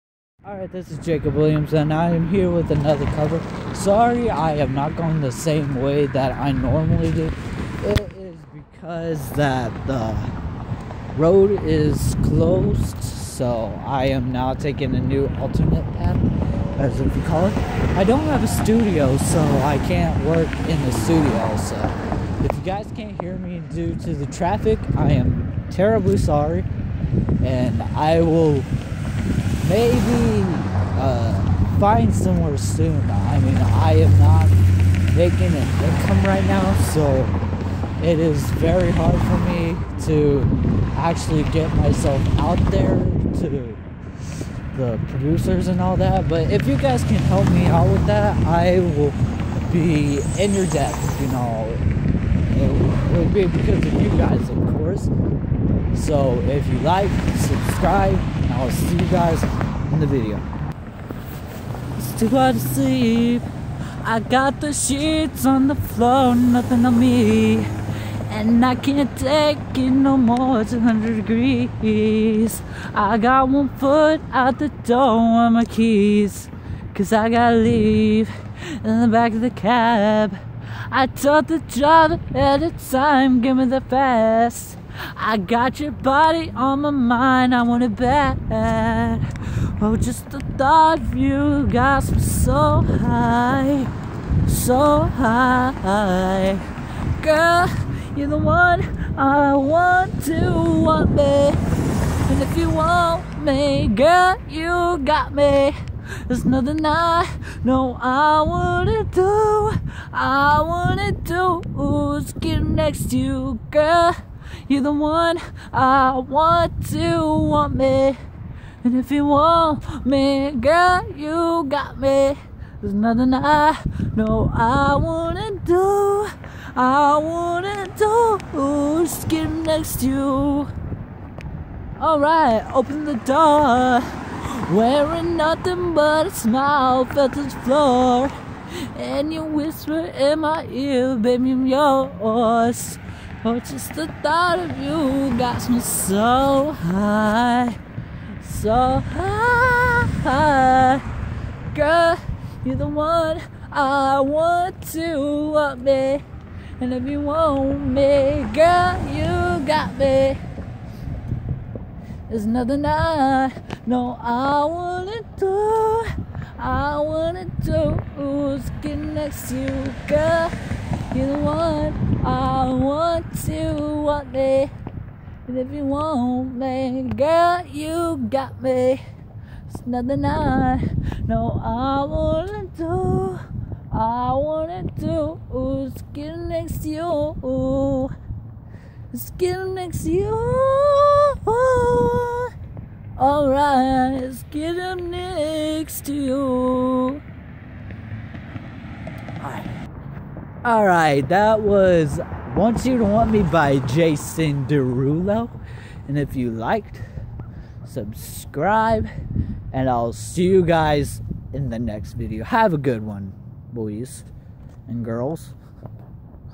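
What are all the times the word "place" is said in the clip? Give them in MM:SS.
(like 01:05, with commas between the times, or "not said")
not said.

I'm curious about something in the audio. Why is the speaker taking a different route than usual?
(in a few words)
The road is closed.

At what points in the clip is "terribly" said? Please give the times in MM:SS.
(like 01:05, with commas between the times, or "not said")
00:25.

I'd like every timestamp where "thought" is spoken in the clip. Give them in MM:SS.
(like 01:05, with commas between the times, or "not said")
01:30, 02:24.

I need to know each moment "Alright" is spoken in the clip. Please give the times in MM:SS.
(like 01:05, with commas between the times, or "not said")
00:00, 02:11, 03:13, 03:19.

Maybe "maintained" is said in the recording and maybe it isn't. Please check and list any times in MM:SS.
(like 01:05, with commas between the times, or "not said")
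not said.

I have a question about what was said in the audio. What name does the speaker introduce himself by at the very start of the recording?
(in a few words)
Jacob Williams.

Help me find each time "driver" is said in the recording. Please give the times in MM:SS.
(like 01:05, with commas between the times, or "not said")
01:21.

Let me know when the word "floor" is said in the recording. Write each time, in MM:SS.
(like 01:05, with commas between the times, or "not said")
01:05, 02:17.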